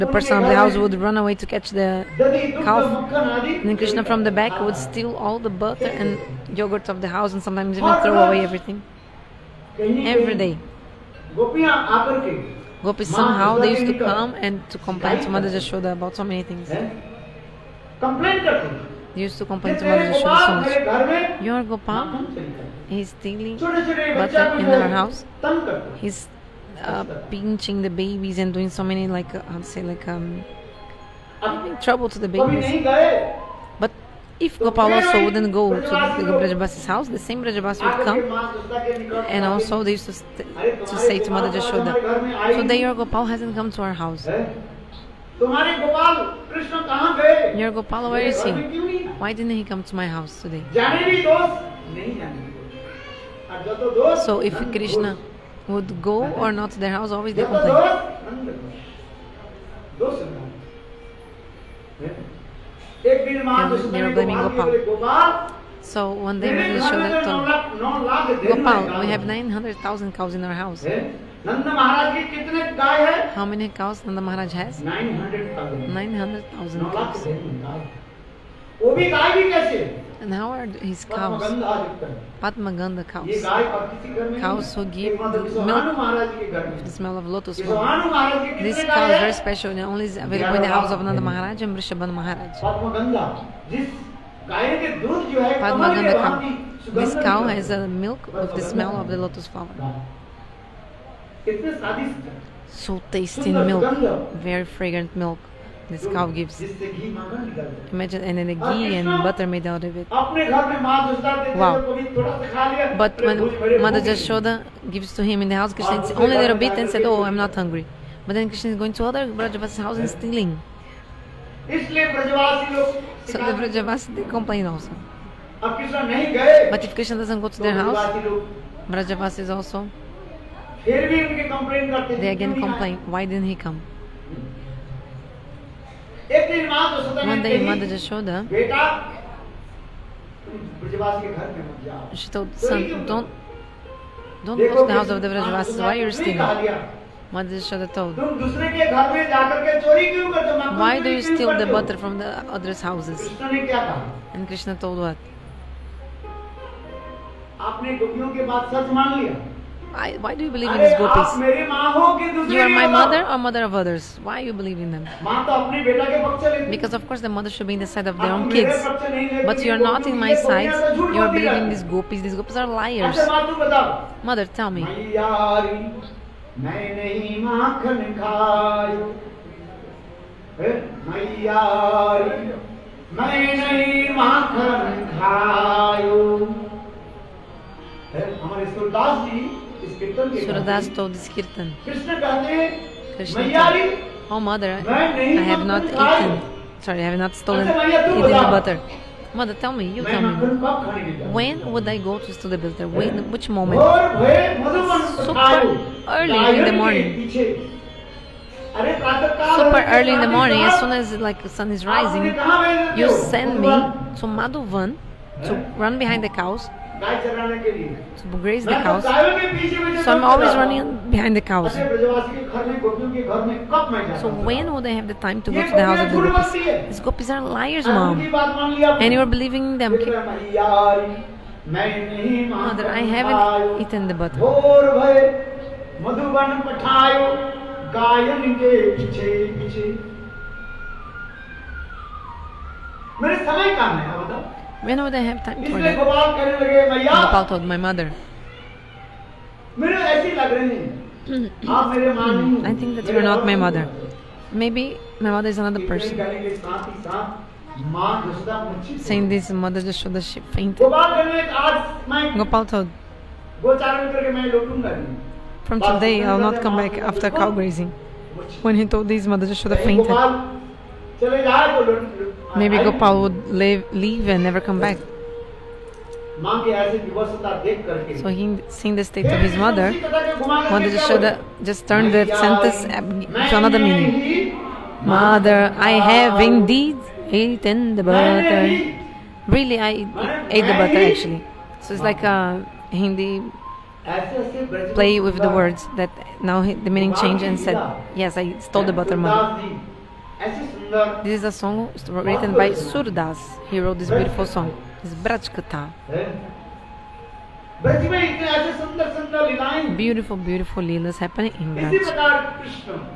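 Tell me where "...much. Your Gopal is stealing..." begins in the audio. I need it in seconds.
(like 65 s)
20 s.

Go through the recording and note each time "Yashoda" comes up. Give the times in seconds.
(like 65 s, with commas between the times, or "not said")
137 s, 147 s.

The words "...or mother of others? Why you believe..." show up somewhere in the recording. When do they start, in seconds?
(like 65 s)
163 s.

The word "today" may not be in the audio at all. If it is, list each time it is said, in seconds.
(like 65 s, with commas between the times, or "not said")
42 s, 50 s, 265 s.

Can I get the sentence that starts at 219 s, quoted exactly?
So I'm always running behind the cows.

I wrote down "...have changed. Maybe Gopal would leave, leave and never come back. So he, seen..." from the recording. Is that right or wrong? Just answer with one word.
wrong.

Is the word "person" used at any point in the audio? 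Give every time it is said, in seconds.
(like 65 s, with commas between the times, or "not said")
0 s, 255 s.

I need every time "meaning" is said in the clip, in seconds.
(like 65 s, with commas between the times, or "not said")
283 s, 296 s.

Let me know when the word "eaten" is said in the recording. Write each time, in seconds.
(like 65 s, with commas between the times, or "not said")
195 s, 233 s, 287 s.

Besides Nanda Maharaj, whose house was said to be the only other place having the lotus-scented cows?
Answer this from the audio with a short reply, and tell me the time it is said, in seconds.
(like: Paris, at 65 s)
Vrishabhan Maharaj, at 91 s.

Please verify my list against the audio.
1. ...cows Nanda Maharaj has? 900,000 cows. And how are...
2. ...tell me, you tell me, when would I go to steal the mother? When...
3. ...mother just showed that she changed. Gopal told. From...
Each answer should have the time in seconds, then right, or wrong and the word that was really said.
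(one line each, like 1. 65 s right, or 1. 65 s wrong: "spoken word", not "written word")
1. 73 s right
2. 199 s wrong: "butter", not "mother"
3. 259 s wrong: "fainted", not "changed".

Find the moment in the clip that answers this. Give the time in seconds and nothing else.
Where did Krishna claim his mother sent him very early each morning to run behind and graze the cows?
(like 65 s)
214 s.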